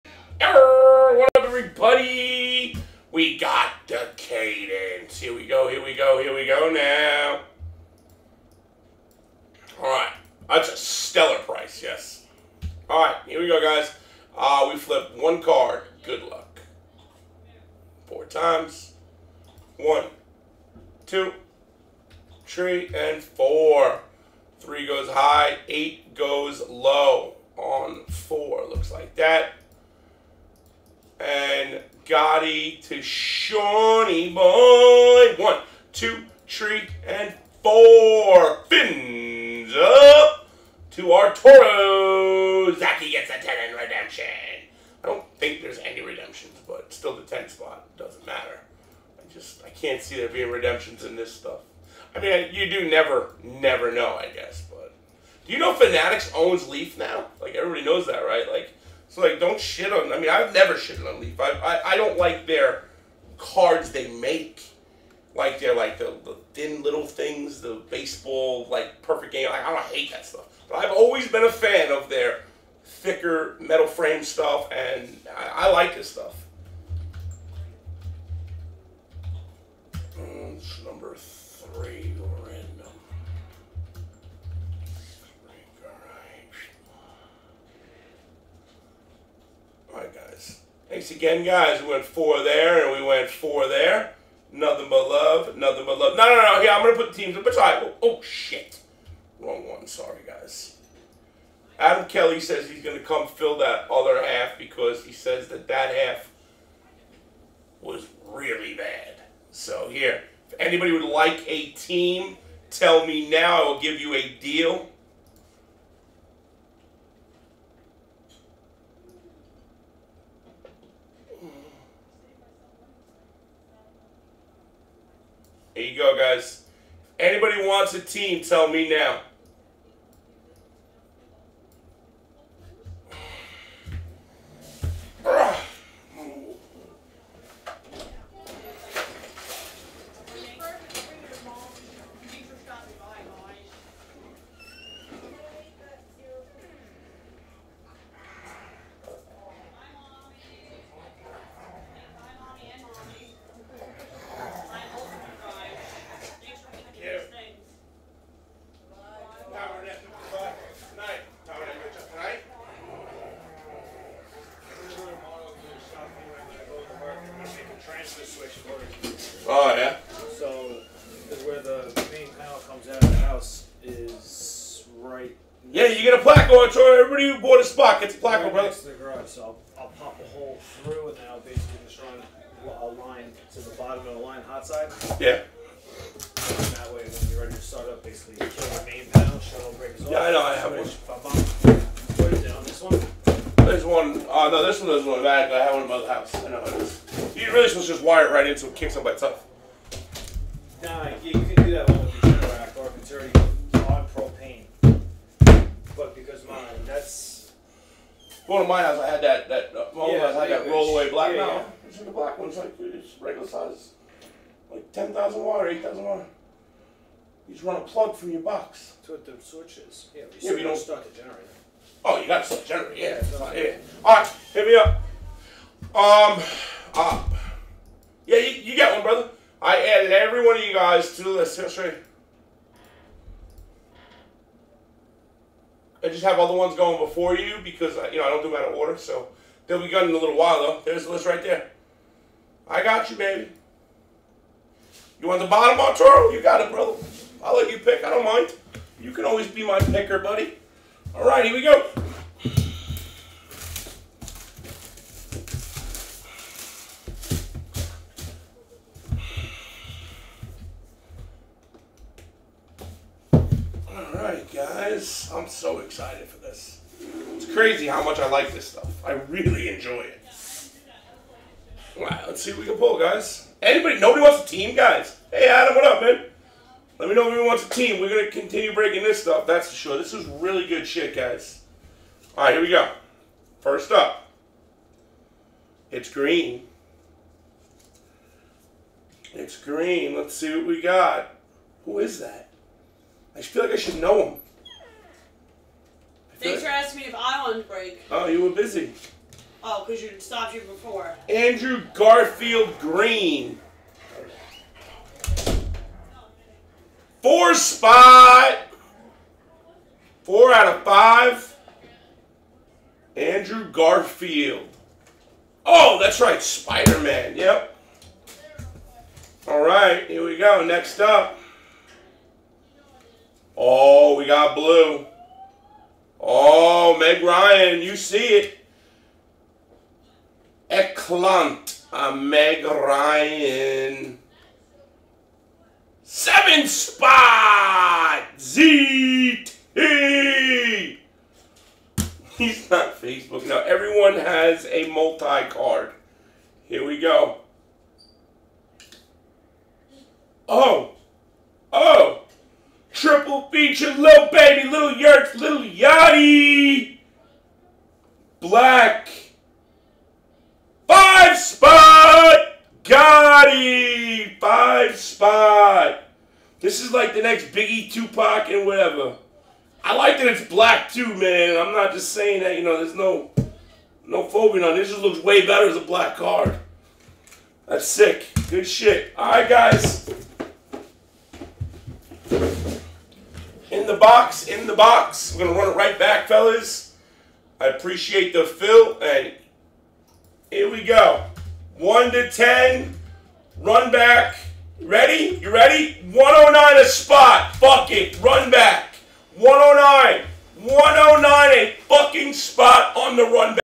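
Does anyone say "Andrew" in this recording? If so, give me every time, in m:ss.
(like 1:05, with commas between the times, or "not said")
5:01, 5:13.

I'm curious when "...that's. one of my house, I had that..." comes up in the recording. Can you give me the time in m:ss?
3:26.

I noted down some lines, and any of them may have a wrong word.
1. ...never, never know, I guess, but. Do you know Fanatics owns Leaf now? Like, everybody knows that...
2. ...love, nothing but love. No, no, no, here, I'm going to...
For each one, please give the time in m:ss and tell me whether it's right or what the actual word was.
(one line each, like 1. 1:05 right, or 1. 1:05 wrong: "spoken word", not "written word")
1. 0:52 right
2. 1:35 right.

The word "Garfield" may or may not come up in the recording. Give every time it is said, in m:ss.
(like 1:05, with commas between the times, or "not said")
5:01, 5:13.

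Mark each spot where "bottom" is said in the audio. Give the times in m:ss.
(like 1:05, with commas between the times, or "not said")
3:03, 4:05.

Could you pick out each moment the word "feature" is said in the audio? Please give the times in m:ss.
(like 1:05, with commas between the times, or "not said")
5:53.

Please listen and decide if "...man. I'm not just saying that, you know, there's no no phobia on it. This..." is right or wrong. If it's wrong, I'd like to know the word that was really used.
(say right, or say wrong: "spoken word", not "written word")
right.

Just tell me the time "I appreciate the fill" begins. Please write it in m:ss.
6:27.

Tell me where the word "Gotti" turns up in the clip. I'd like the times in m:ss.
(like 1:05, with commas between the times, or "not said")
0:32, 6:02.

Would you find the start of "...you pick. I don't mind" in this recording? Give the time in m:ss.
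4:07.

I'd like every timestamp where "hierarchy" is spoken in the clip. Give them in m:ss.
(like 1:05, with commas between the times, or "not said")
not said.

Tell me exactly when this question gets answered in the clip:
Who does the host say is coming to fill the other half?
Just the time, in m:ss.
1:41.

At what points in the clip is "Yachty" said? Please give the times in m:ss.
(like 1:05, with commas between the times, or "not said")
5:55.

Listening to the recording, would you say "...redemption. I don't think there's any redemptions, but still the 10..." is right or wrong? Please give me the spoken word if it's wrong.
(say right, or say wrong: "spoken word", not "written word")
right.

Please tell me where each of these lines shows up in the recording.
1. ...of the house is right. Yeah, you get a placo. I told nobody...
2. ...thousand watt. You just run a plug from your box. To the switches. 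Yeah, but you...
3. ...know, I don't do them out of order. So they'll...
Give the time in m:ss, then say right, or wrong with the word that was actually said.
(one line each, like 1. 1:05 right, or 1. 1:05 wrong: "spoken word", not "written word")
1. 2:53 wrong: "everybody", not "nobody"
2. 3:35 right
3. 3:58 right.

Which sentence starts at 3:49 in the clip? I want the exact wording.
I added every one of you guys to the list.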